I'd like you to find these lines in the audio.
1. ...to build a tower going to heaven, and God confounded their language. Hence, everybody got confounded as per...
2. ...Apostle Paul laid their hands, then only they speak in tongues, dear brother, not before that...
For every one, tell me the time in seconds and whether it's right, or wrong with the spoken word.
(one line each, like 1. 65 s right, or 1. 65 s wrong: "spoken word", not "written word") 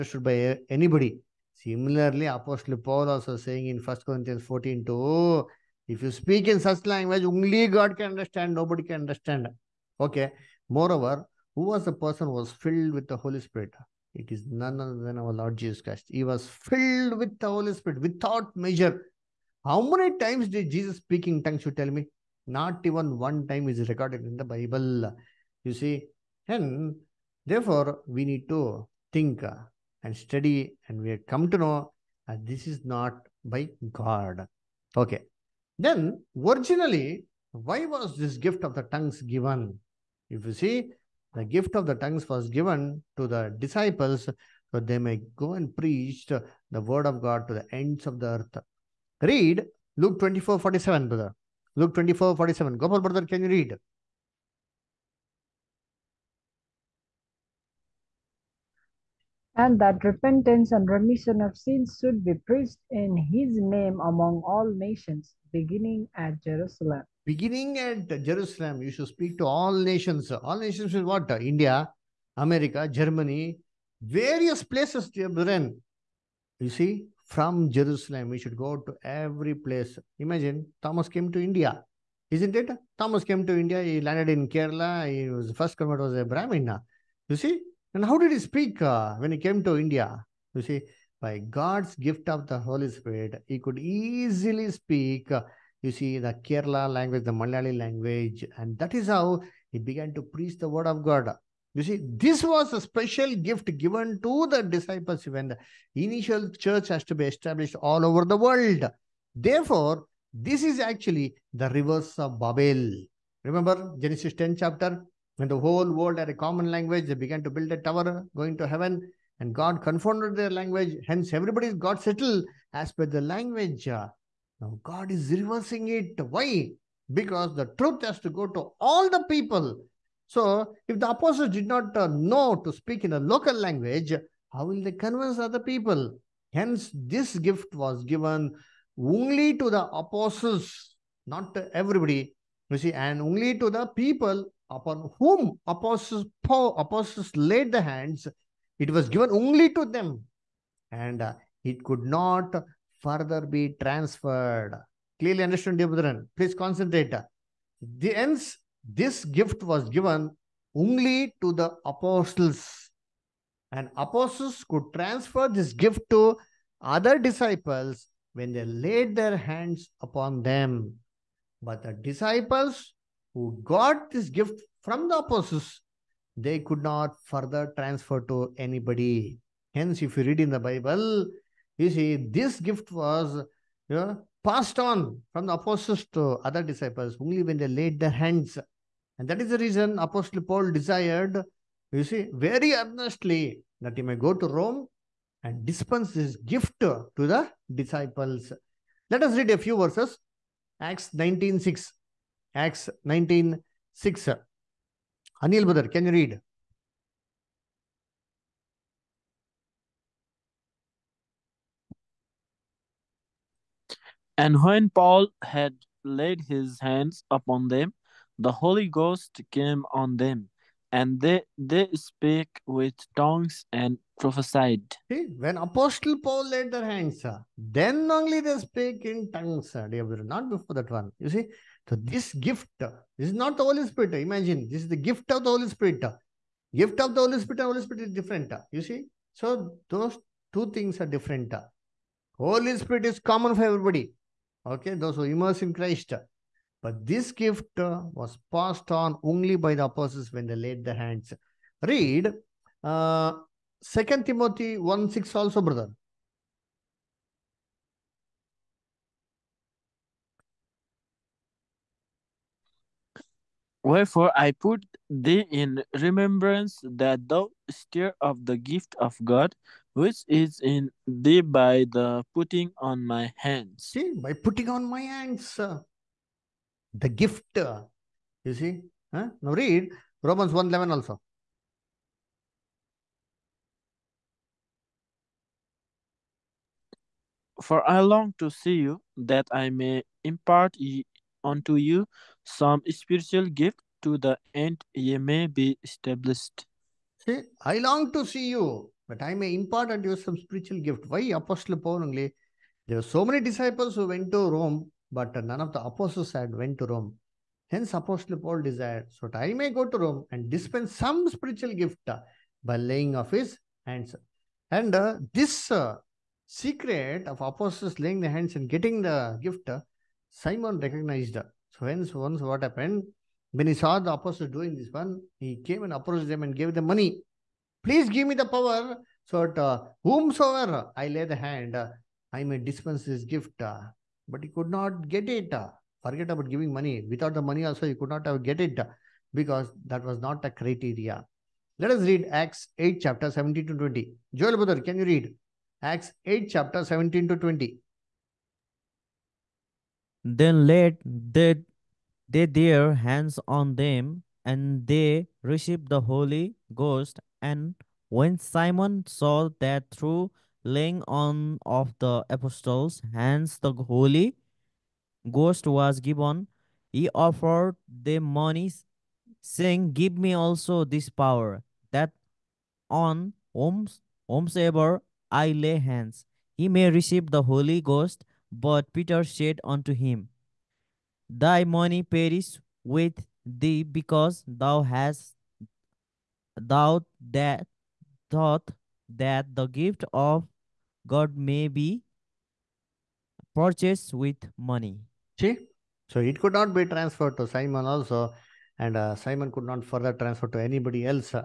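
1. 117 s wrong: "settled", not "confounded"
2. 225 s right.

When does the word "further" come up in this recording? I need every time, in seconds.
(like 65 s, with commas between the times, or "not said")
152 s, 177 s, 399 s.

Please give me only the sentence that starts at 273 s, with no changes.
See, by putting on my hands.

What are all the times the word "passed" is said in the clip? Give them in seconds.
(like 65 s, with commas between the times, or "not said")
184 s, 248 s.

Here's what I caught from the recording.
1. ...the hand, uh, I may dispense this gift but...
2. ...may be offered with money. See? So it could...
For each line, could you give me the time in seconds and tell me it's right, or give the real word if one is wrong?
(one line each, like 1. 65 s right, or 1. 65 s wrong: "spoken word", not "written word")
1. 331 s right
2. 391 s wrong: "purchased", not "offered".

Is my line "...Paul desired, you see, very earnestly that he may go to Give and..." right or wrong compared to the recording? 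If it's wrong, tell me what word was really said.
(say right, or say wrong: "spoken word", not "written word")
wrong: "Rome", not "Give".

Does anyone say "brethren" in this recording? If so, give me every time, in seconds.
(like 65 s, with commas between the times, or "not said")
75 s, 155 s.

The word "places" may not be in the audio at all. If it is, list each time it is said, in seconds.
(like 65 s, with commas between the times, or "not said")
74 s, 79 s.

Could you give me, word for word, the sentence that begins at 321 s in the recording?
So hence, once what happened, when he saw the apostles doing this one, he came and approached them and gave them money.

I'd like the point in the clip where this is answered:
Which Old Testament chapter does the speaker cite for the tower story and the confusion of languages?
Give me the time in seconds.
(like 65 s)
113 s.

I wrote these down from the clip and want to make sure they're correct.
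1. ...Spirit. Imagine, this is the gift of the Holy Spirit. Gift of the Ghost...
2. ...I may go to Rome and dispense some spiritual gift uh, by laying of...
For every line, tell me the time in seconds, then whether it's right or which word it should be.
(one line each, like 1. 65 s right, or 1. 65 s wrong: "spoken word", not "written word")
1. 233 s wrong: "Holy", not "Ghost"
2. 309 s right.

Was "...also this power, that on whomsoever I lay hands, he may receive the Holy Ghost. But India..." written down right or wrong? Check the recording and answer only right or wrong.
wrong.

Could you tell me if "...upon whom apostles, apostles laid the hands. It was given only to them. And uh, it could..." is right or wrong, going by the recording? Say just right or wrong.
right.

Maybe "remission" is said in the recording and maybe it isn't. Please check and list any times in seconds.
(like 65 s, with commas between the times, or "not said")
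60 s.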